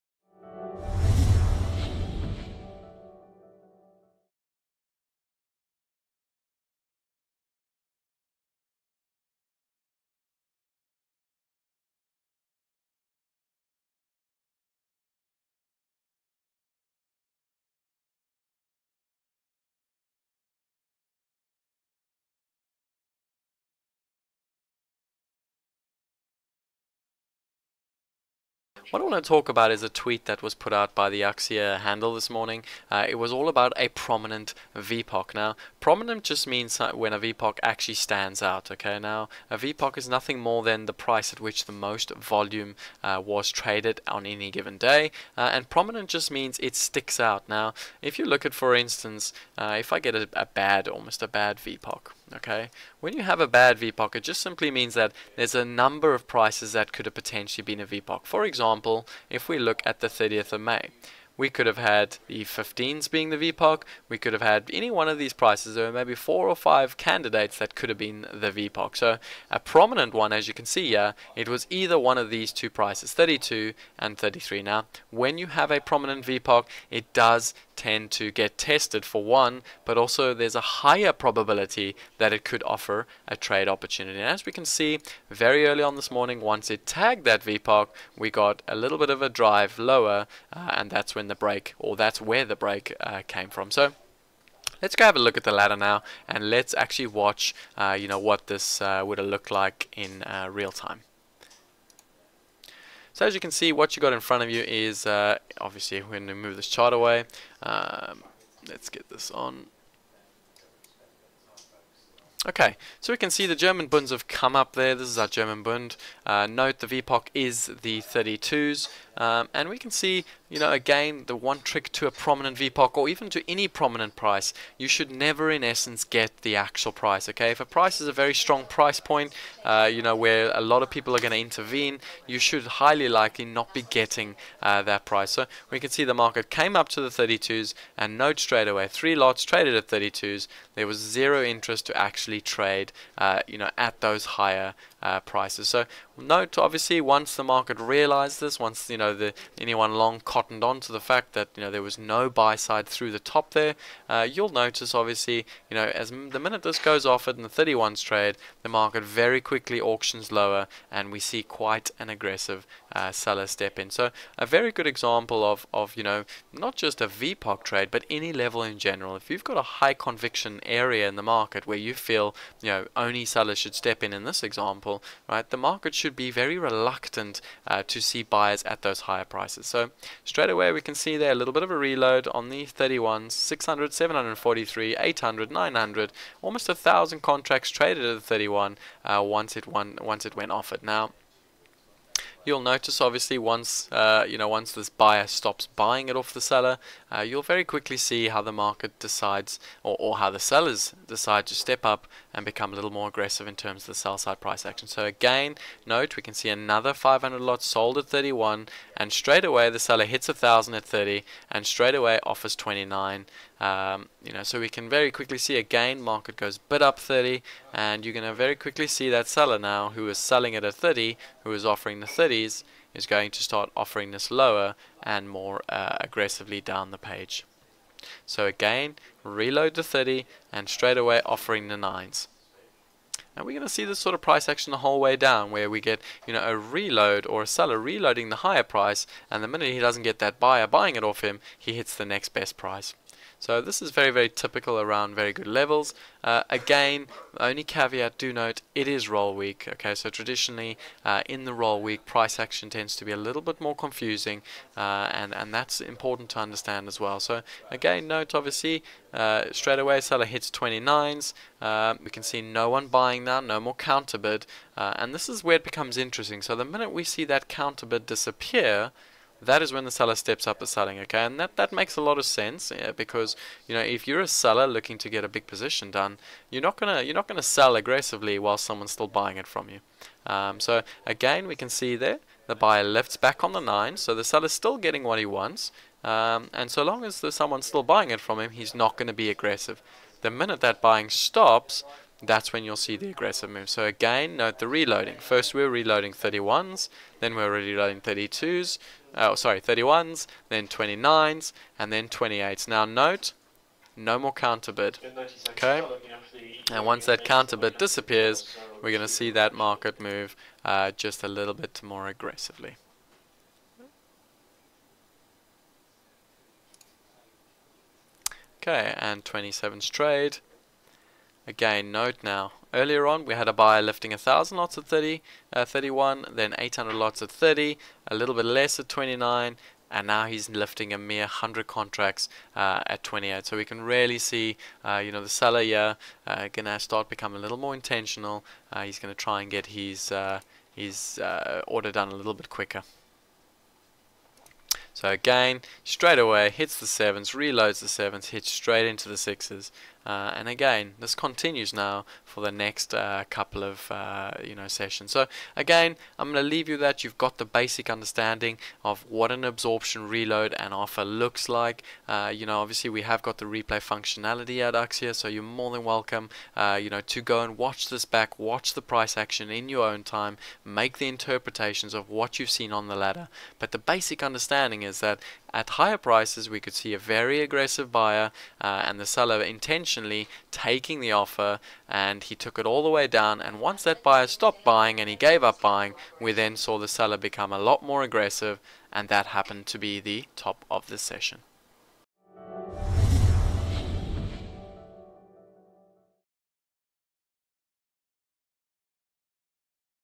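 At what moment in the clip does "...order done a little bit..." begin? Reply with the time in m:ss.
5:41.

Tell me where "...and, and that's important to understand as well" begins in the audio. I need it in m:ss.
4:15.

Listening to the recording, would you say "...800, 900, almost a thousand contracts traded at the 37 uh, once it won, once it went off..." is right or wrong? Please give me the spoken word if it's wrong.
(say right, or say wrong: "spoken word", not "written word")
wrong: "31", not "37".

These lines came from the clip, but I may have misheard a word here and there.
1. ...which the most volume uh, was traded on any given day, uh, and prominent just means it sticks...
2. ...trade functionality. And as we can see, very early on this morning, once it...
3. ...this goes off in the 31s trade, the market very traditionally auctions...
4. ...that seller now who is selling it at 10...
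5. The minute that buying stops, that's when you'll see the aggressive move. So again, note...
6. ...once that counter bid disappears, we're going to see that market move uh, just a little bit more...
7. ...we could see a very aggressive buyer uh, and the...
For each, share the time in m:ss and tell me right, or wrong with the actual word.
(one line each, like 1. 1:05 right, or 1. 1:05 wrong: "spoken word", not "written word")
1. 0:41 right
2. 1:23 wrong: "opportunity", not "functionality"
3. 2:36 wrong: "quickly", not "traditionally"
4. 3:39 wrong: "30", not "10"
5. 4:50 right
6. 5:06 right
7. 6:16 right.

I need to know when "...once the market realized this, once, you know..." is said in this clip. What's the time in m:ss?
2:27.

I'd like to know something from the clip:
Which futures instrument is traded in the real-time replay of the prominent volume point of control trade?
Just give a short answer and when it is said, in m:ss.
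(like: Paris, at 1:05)
German Bund, at 1:55.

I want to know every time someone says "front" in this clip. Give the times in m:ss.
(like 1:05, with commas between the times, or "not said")
1:44.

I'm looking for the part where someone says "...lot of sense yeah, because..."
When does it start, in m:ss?
4:32.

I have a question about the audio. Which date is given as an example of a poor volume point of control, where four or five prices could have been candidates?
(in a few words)
30th of May.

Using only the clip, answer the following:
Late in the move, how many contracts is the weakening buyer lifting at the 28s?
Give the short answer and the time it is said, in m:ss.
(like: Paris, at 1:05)
100, at 5:31.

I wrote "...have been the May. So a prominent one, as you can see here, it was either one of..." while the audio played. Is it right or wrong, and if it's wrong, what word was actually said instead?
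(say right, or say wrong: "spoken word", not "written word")
wrong: "VPOC", not "May".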